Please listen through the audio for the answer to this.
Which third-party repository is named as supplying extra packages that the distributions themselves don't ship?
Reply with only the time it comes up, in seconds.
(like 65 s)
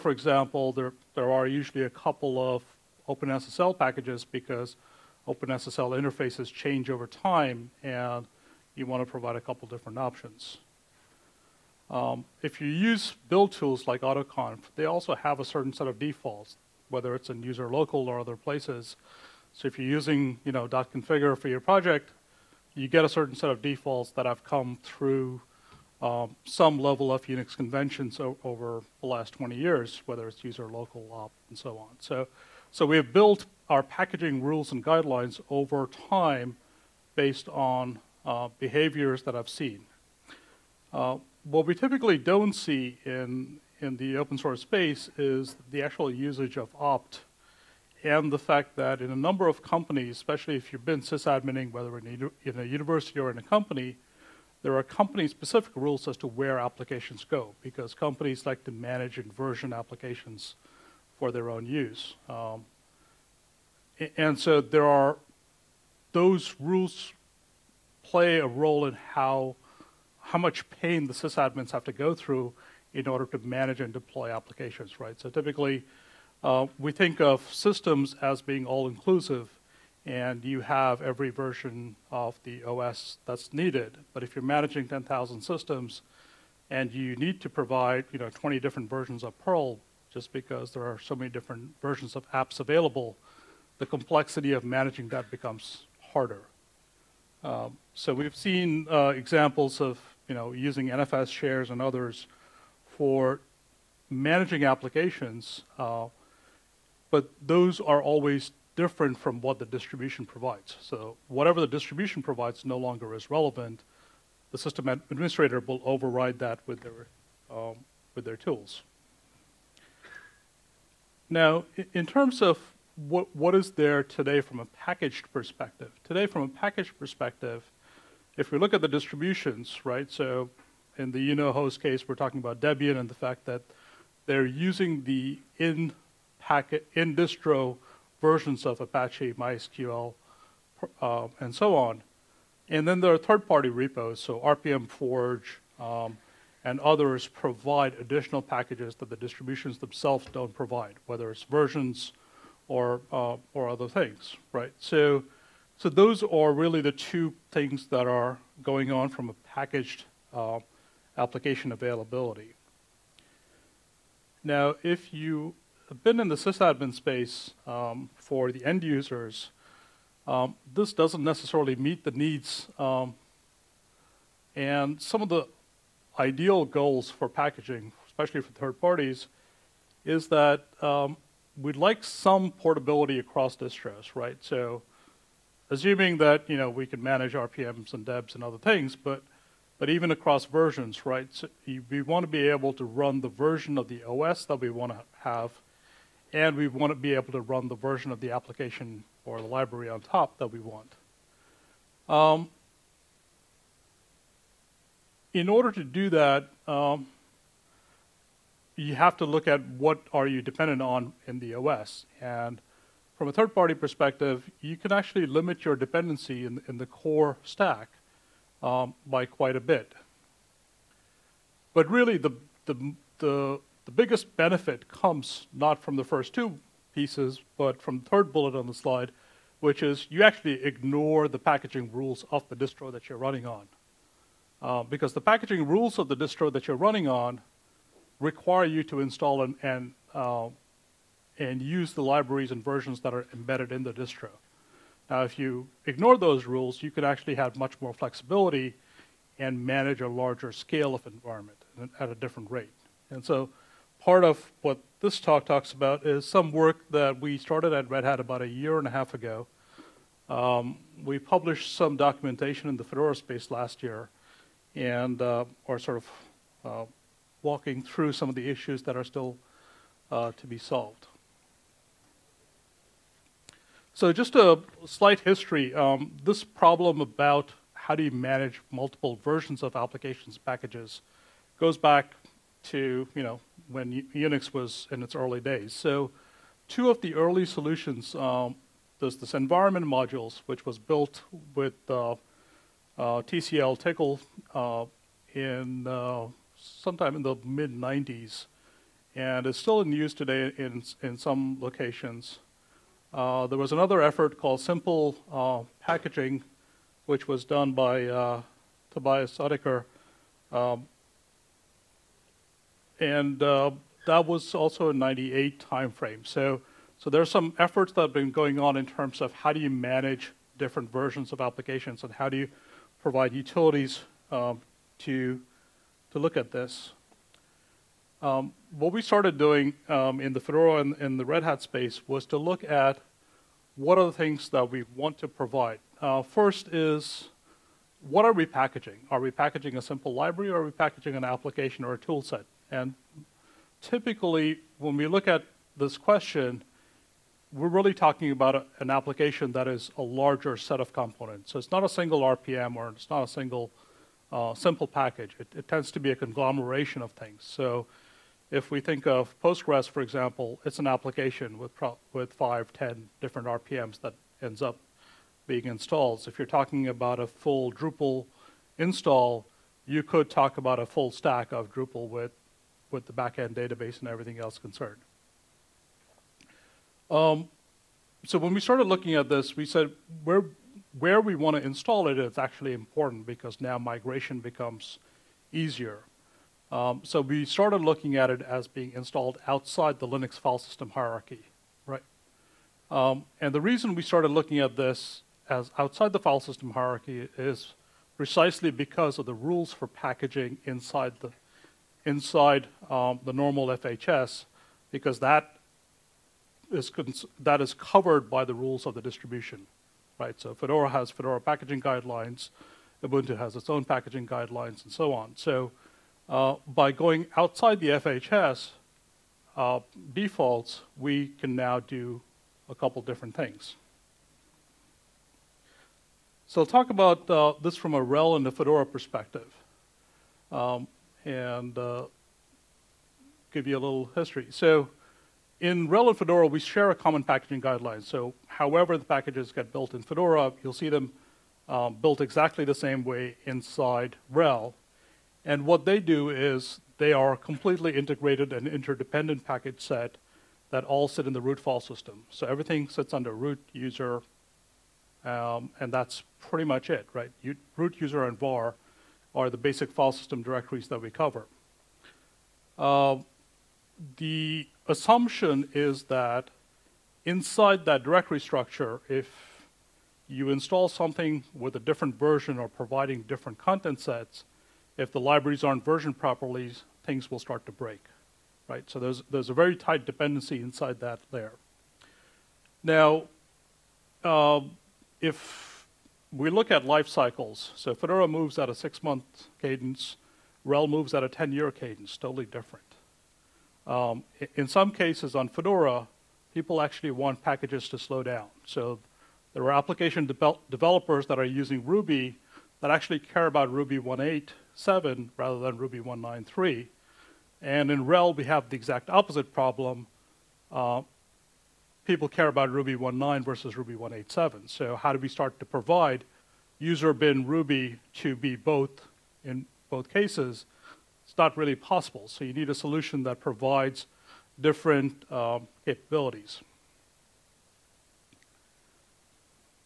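144 s.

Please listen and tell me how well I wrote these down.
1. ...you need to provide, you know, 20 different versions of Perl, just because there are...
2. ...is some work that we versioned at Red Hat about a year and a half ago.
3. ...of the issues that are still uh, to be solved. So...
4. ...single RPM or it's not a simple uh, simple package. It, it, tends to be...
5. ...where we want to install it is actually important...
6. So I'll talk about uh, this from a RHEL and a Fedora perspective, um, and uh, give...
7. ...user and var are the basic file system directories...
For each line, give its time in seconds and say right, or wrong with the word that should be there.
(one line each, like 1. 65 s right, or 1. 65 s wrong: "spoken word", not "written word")
1. 86 s right
2. 256 s wrong: "started", not "versioned"
3. 268 s right
4. 351 s wrong: "single", not "simple"
5. 380 s right
6. 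426 s right
7. 458 s right.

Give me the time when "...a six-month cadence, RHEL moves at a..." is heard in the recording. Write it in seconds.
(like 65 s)
488 s.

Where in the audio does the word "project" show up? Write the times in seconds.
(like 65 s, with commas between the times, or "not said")
21 s.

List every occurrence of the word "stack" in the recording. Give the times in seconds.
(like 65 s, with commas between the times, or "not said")
217 s, 371 s.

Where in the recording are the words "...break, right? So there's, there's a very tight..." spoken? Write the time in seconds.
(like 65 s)
477 s.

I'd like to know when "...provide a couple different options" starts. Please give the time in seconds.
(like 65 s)
9 s.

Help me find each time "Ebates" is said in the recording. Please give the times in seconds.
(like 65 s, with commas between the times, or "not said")
not said.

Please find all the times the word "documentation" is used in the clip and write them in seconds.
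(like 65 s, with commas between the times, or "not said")
261 s.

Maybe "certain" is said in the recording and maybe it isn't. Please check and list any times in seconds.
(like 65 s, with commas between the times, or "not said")
15 s, 23 s.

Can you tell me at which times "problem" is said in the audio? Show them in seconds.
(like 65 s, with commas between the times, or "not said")
276 s, 509 s.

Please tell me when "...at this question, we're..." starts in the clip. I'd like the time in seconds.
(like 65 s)
345 s.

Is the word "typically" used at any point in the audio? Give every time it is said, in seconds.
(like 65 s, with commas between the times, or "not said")
41 s, 75 s, 343 s.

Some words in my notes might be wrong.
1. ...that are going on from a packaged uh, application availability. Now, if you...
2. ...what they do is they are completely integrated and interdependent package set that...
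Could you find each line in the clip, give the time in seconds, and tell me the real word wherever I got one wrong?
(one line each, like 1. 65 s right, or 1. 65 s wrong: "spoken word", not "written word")
1. 157 s right
2. 445 s right.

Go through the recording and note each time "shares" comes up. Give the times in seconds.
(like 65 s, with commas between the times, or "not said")
101 s, 436 s.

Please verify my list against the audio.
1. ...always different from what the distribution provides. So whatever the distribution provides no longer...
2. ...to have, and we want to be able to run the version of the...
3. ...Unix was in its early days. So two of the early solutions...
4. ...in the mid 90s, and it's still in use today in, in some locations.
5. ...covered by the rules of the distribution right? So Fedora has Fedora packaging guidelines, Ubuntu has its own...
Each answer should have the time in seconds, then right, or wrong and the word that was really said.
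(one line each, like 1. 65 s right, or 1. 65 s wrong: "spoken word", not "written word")
1. 108 s right
2. 194 s right
3. 284 s right
4. 297 s right
5. 407 s right.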